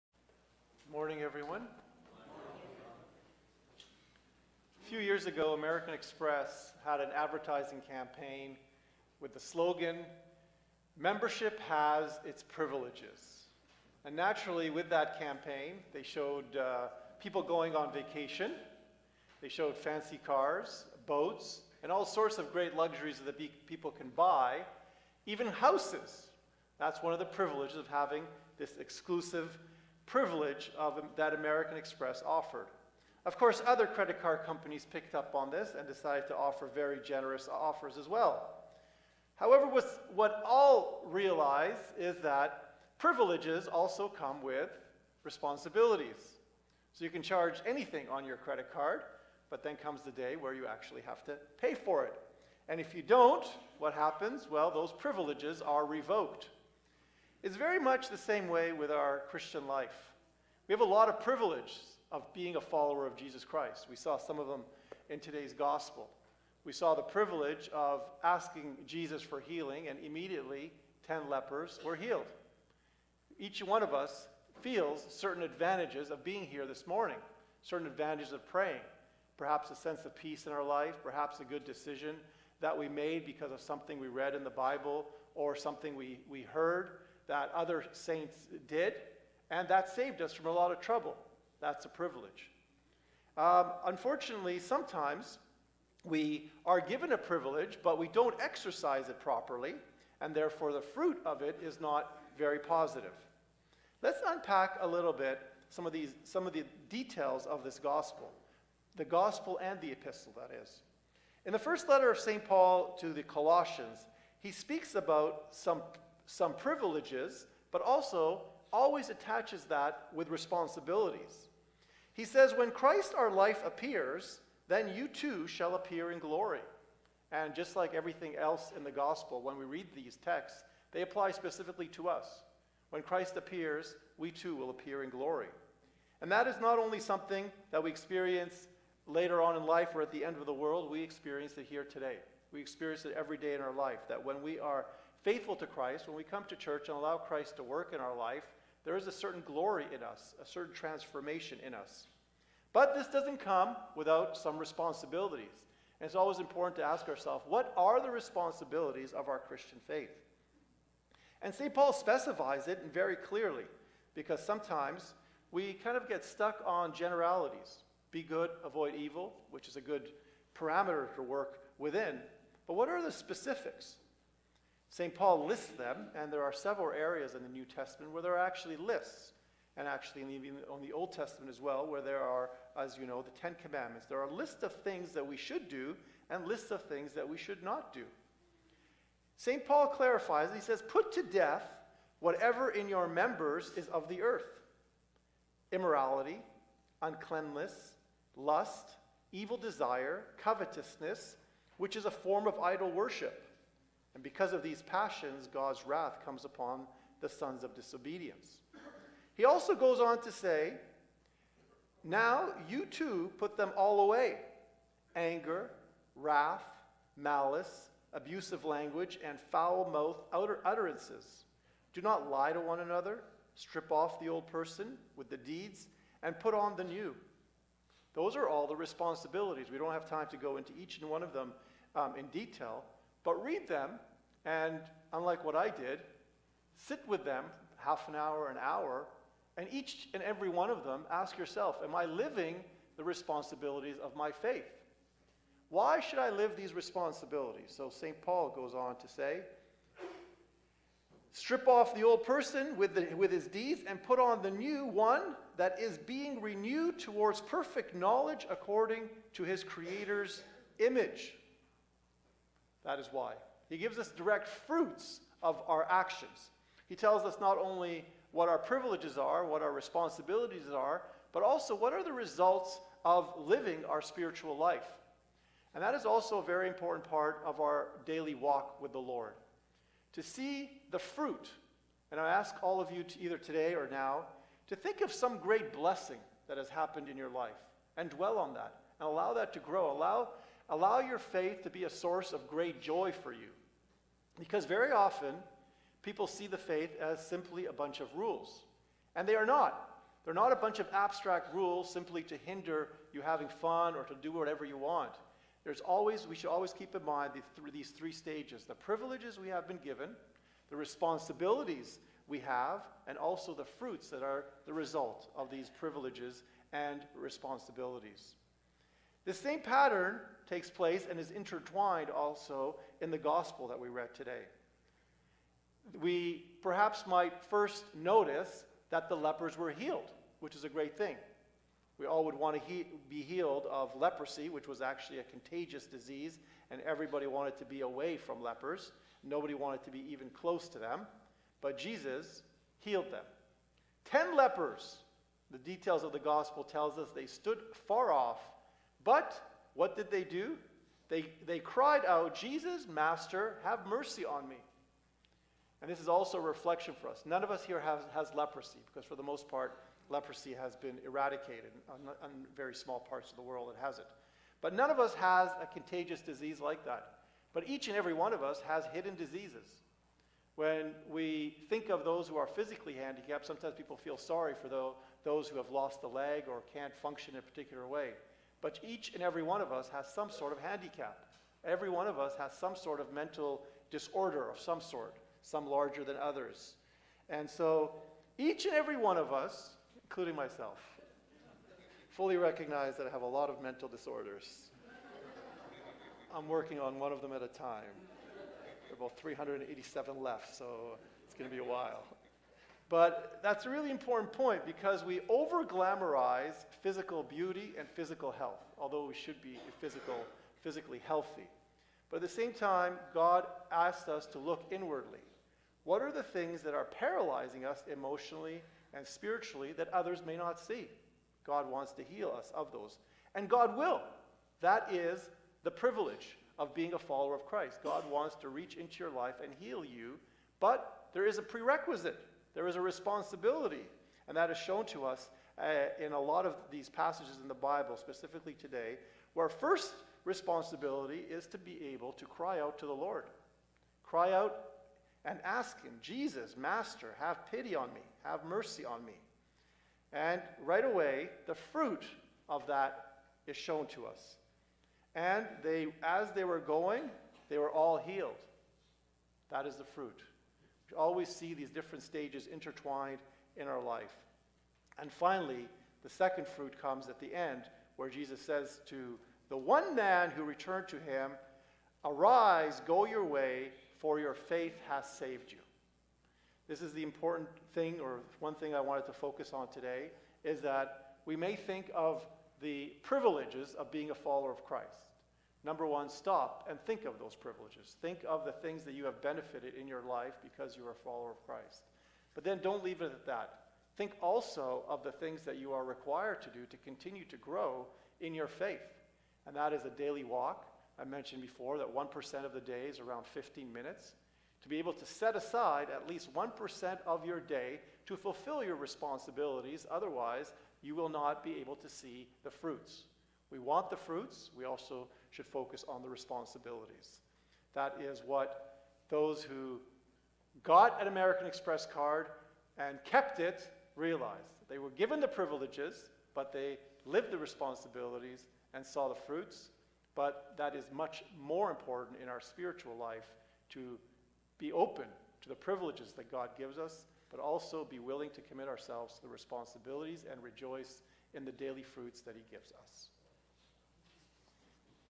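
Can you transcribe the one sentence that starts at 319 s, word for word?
The same pattern takes place and is intertwined also in the gospel that we read today.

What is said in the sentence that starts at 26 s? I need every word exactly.
That's one of the privileges of having this exclusive privilege of, that American Express offered.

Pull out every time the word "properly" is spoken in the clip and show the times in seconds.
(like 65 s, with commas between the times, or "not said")
99 s.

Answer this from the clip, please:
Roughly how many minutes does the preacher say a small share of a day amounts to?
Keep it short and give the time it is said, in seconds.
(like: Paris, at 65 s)
15, at 503 s.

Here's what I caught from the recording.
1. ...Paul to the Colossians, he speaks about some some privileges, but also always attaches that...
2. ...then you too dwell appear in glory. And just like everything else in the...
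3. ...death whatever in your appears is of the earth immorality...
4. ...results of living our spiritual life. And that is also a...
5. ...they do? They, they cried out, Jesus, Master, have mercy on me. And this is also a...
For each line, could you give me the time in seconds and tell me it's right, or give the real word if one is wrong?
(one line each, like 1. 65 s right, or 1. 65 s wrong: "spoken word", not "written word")
1. 112 s right
2. 124 s wrong: "shall", not "dwell"
3. 191 s wrong: "members", not "appears"
4. 272 s right
5. 350 s right.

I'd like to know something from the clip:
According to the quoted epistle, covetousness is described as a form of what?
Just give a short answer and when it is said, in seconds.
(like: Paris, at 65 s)
idol worship, at 202 s.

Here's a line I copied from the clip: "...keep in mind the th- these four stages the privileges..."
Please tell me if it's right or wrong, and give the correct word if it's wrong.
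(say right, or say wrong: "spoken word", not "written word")
wrong: "three", not "four".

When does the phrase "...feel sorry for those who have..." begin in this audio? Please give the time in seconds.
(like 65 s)
373 s.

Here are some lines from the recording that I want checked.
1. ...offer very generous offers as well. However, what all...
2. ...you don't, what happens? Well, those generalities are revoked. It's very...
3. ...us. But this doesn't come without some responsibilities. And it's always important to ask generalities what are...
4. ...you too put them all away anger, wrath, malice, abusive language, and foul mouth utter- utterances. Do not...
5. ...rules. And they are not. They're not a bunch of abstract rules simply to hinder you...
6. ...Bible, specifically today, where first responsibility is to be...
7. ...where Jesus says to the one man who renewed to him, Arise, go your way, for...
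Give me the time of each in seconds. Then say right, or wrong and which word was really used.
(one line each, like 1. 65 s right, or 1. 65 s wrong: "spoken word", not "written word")
1. 36 s right
2. 52 s wrong: "privileges", not "generalities"
3. 151 s wrong: "ourselves", not "generalities"
4. 212 s right
5. 298 s right
6. 437 s right
7. 467 s wrong: "returned", not "renewed".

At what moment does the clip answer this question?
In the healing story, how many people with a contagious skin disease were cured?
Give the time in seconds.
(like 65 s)
71 s.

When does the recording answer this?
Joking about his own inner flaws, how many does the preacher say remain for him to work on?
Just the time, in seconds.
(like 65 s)
399 s.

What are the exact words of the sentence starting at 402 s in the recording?
But that's a really important point because we over glamorize physical beauty and physical health, although we should be physical, physically healthy.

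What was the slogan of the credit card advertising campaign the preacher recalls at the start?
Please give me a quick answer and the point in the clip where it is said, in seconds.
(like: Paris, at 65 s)
Membership has its privileges, at 10 s.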